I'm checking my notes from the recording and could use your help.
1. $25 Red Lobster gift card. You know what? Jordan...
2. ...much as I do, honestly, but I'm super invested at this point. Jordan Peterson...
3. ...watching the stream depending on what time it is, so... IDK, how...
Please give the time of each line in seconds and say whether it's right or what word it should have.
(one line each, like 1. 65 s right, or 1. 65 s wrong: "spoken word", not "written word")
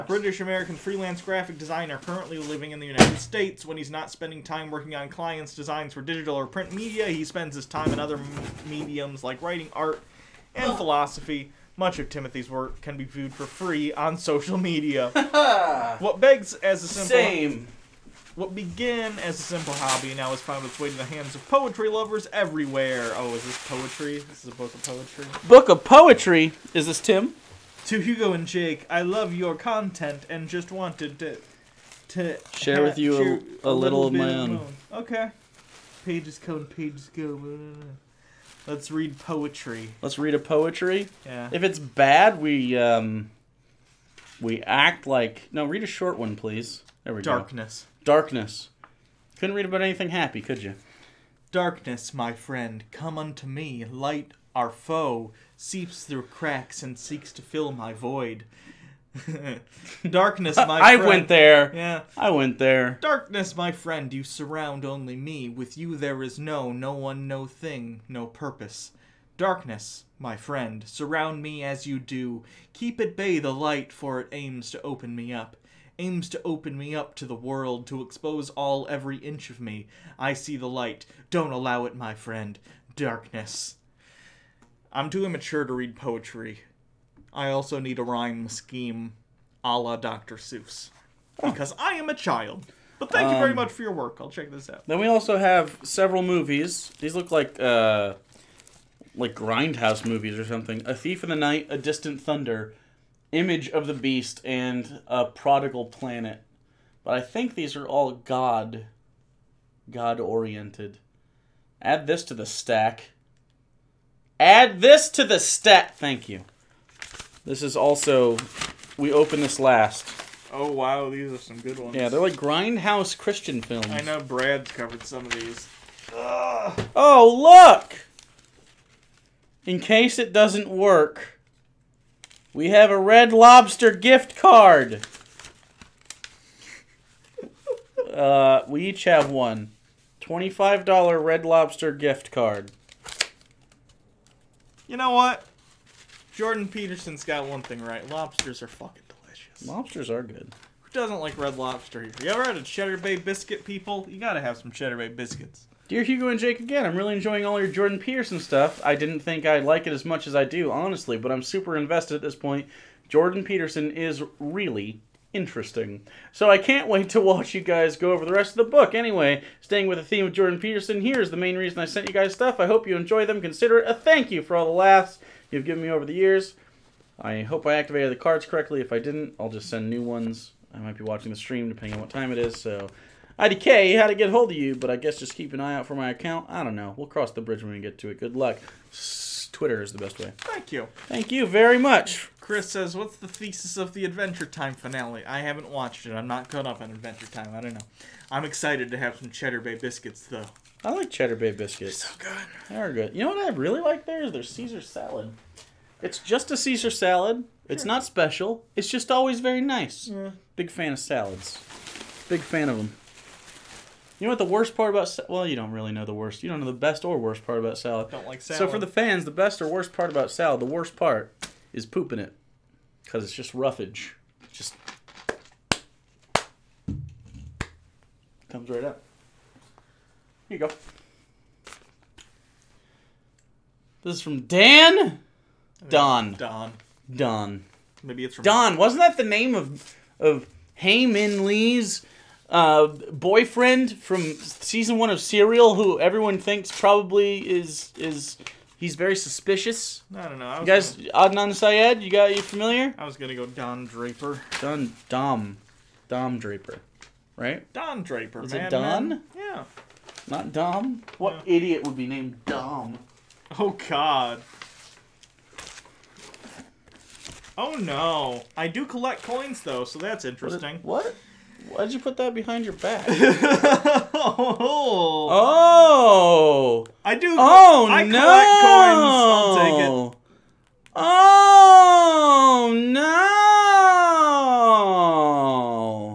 1. 140 s right
2. 160 s right
3. 181 s right.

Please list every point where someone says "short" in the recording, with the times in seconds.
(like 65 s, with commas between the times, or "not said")
45 s.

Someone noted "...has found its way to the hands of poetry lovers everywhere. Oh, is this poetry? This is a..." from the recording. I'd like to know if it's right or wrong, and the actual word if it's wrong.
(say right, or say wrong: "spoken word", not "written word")
right.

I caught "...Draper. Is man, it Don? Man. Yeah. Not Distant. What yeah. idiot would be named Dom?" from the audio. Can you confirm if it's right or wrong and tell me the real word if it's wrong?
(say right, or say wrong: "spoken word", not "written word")
wrong: "Dom", not "Distant".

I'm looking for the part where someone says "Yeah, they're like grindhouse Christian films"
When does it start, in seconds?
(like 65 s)
121 s.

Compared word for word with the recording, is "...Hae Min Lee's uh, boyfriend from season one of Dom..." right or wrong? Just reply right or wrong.
wrong.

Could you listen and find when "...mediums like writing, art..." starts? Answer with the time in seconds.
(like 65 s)
8 s.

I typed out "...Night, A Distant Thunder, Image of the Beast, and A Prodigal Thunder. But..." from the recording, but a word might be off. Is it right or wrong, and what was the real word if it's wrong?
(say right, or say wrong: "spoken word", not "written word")
wrong: "Planet", not "Thunder".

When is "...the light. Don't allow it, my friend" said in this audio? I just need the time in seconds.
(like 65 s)
80 s.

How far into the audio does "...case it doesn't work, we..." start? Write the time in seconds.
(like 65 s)
129 s.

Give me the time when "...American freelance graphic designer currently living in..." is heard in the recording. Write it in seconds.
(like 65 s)
0 s.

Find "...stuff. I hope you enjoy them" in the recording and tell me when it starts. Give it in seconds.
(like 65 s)
172 s.